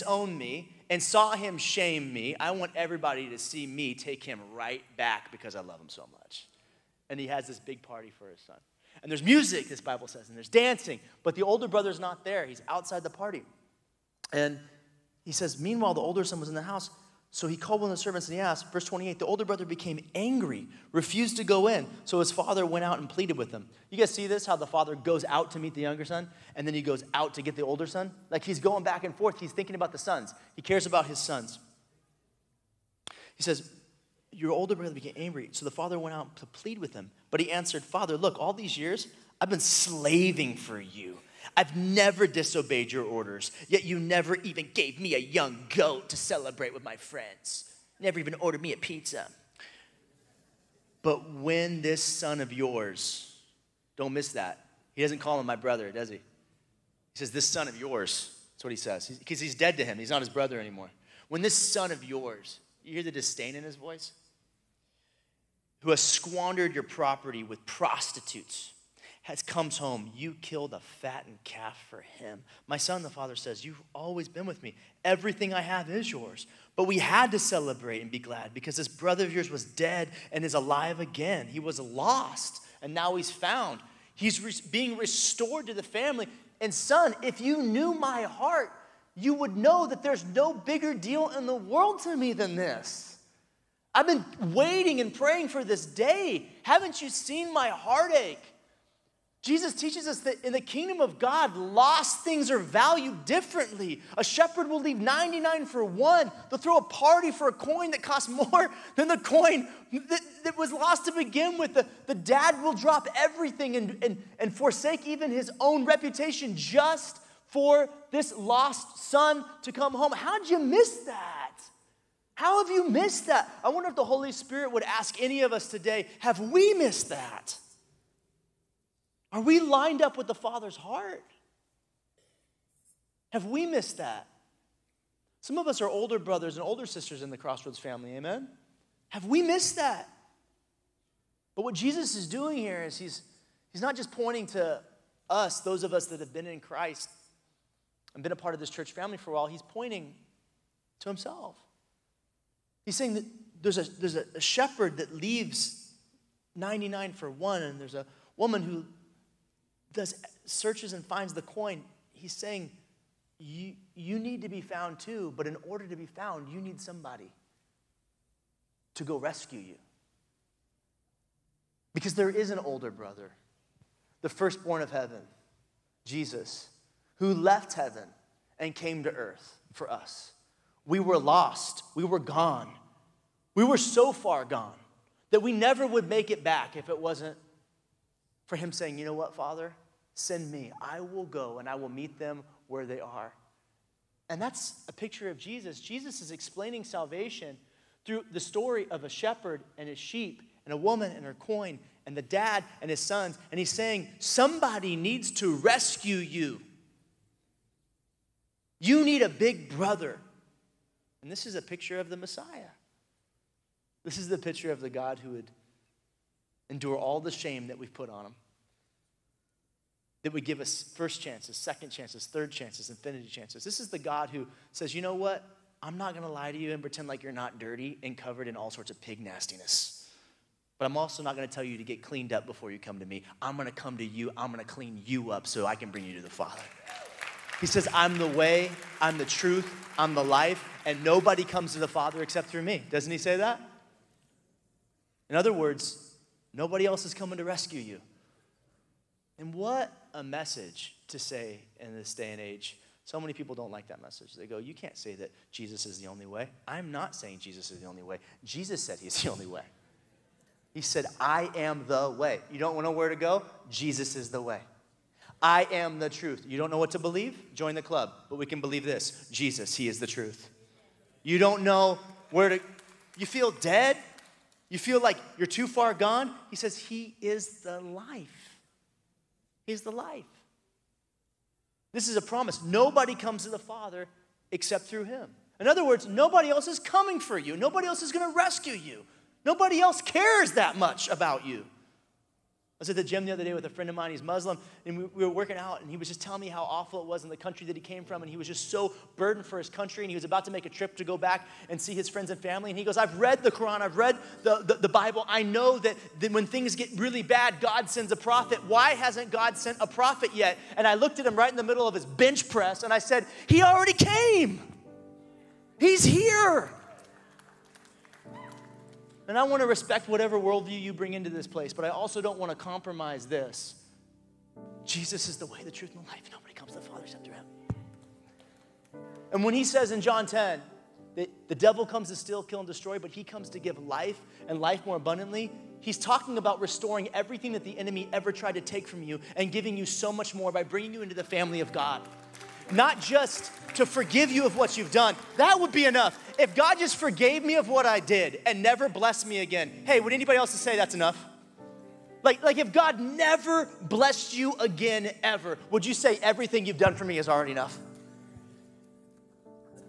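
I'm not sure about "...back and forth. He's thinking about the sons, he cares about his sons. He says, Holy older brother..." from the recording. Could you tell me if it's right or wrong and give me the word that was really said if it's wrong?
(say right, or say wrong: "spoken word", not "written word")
wrong: "Your", not "Holy".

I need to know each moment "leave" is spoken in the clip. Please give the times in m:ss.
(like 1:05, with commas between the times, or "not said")
1:44, 2:35.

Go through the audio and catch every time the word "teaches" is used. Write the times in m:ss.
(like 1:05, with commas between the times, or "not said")
1:39.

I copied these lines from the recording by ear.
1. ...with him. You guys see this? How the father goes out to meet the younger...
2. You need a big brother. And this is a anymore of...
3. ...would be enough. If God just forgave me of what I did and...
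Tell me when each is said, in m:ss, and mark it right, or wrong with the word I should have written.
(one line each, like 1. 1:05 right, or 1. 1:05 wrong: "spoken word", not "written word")
1. 0:23 right
2. 3:28 wrong: "picture", not "anymore"
3. 5:45 right.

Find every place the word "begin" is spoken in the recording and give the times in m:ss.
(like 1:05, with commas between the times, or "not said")
1:51.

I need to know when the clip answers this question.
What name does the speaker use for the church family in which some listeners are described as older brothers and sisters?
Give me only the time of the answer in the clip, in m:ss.
2:17.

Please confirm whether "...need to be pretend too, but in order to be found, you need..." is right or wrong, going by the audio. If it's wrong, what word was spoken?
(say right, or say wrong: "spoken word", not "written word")
wrong: "found", not "pretend".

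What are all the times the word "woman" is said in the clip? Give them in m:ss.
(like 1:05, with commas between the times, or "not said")
2:38, 3:20.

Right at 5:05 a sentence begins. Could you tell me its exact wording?
I know that, that when things get really bad, God sends a prophet.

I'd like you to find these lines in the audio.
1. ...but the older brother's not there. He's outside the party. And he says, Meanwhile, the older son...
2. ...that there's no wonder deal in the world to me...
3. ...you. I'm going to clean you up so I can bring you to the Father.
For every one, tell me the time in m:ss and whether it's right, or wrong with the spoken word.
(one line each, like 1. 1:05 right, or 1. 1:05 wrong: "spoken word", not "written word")
1. 0:11 right
2. 1:29 wrong: "bigger", not "wonder"
3. 3:54 right.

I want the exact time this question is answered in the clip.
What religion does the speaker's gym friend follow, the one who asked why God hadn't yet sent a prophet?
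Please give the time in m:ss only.
4:54.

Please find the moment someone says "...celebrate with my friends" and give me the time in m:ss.
0:46.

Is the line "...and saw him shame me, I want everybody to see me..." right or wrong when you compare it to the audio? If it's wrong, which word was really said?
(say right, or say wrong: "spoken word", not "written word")
right.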